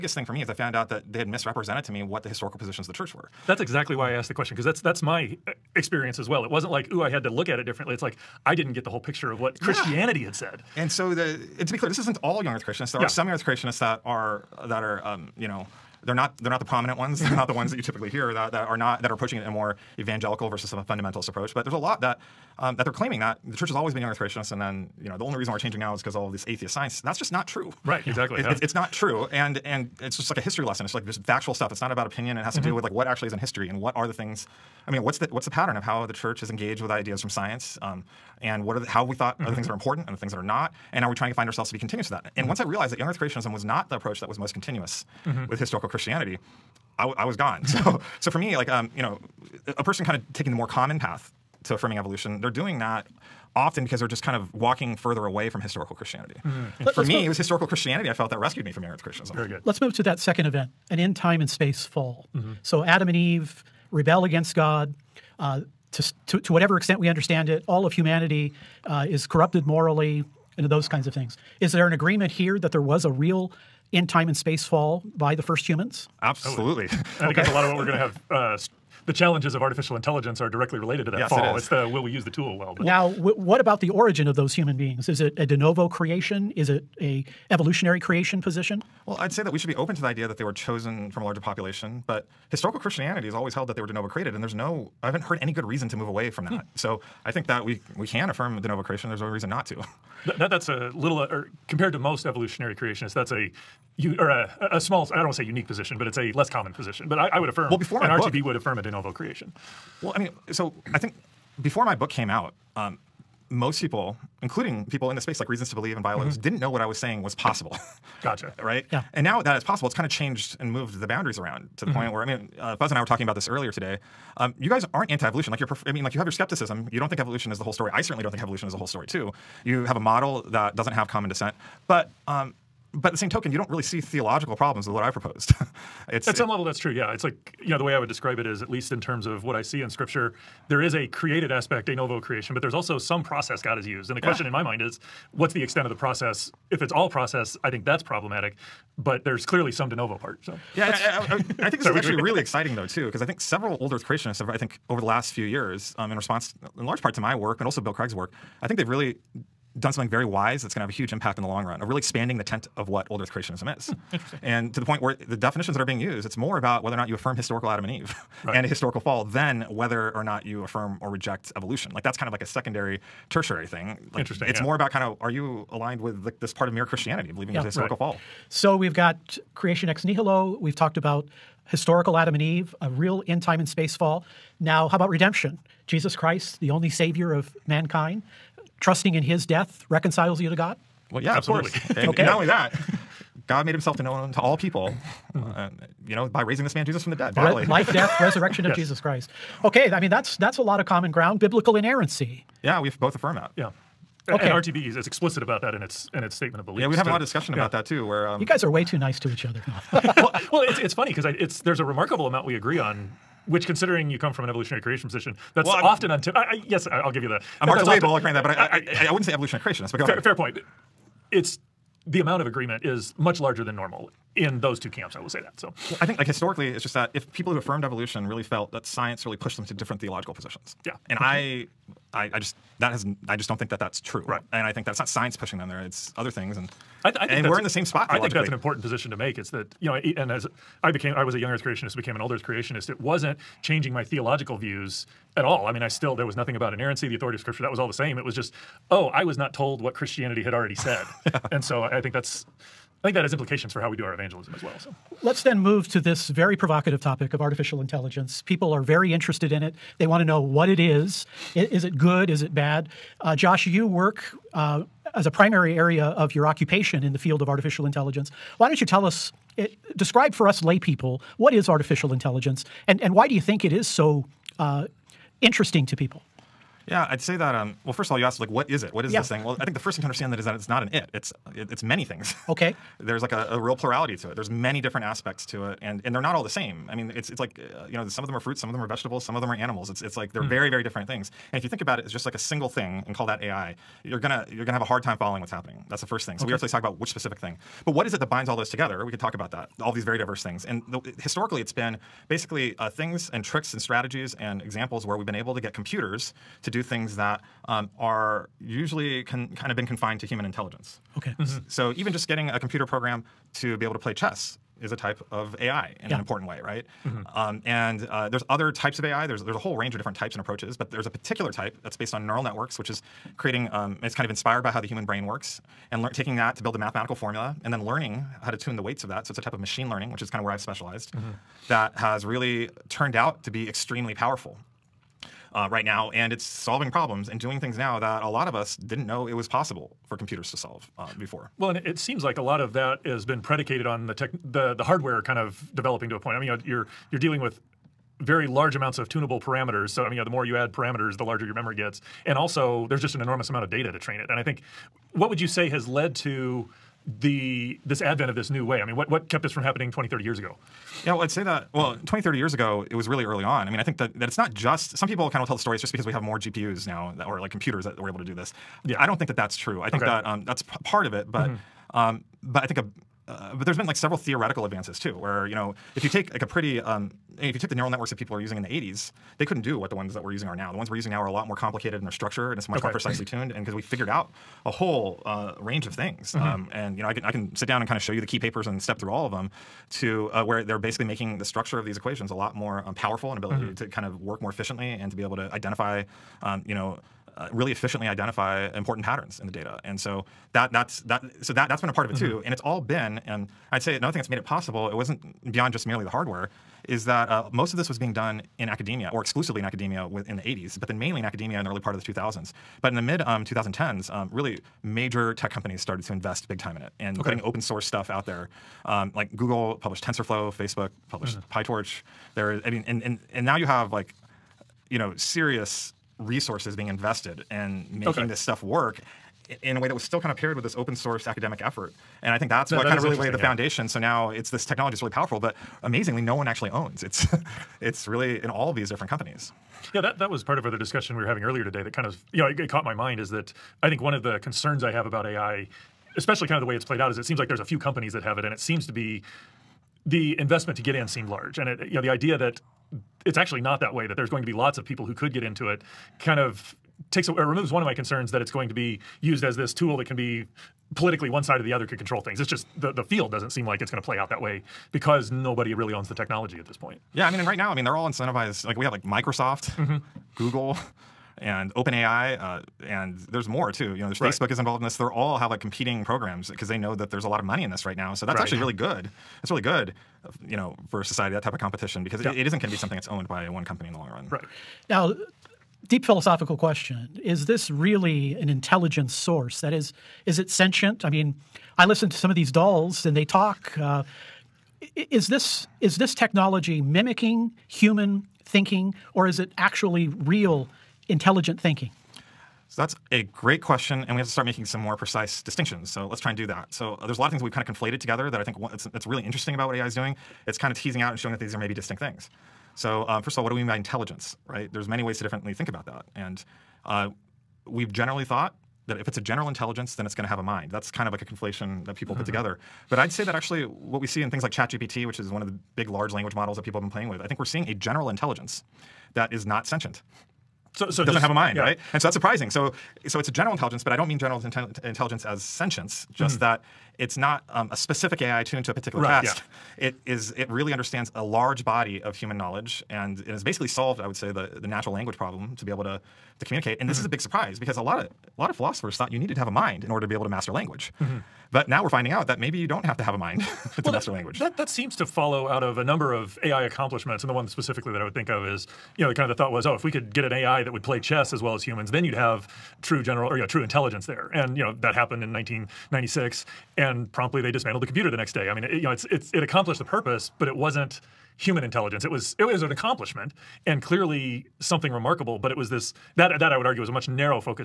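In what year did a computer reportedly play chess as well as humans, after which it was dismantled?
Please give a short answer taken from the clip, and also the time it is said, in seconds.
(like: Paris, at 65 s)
1996, at 565 s.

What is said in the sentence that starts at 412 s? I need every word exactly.
But in the mid um, 2010s, um, really major tech companies started to invest big time in it and okay.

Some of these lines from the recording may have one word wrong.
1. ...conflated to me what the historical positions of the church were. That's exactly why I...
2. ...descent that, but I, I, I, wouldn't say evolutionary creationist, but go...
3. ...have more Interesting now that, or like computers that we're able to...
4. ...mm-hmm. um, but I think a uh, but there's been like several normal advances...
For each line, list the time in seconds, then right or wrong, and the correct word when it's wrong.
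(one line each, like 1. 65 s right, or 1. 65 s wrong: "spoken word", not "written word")
1. 1 s wrong: "misrepresented", not "conflated"
2. 218 s wrong: "grant", not "descent"
3. 366 s wrong: "GPUs", not "Interesting"
4. 371 s wrong: "theoretical", not "normal".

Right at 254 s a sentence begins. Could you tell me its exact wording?
So let's then move to this very provocative topic of artificial intelligence.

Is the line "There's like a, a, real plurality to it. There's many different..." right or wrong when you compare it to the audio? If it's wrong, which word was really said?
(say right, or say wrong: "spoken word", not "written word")
right.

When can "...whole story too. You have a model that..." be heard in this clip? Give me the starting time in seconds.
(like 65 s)
128 s.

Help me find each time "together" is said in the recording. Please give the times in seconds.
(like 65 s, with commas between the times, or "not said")
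298 s, 507 s, 522 s.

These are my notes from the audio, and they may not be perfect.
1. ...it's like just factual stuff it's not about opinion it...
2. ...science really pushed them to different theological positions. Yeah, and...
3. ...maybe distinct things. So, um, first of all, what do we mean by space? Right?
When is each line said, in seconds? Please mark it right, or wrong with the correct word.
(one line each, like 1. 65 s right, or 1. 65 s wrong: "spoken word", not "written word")
1. 30 s right
2. 228 s right
3. 511 s wrong: "intelligence", not "space".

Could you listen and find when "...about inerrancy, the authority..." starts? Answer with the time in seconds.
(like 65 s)
246 s.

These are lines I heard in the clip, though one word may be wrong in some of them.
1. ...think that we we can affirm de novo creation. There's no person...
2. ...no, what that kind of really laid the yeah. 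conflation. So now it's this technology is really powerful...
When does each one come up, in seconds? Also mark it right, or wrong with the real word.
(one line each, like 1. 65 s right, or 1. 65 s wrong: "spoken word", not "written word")
1. 97 s wrong: "reason", not "person"
2. 432 s wrong: "foundation", not "conflation".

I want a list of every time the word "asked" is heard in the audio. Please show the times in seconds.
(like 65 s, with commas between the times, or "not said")
4 s, 278 s.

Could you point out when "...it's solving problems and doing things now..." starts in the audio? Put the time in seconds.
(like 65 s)
336 s.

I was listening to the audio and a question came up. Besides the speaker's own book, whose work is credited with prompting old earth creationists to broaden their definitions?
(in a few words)
Bill Craig.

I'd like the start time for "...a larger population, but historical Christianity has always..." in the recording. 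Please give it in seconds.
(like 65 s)
91 s.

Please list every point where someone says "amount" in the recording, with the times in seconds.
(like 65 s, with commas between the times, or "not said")
212 s, 222 s, 348 s, 353 s.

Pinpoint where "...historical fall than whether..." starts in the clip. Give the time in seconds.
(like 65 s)
168 s.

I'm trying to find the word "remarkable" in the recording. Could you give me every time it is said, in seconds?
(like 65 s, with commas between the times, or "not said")
211 s, 574 s.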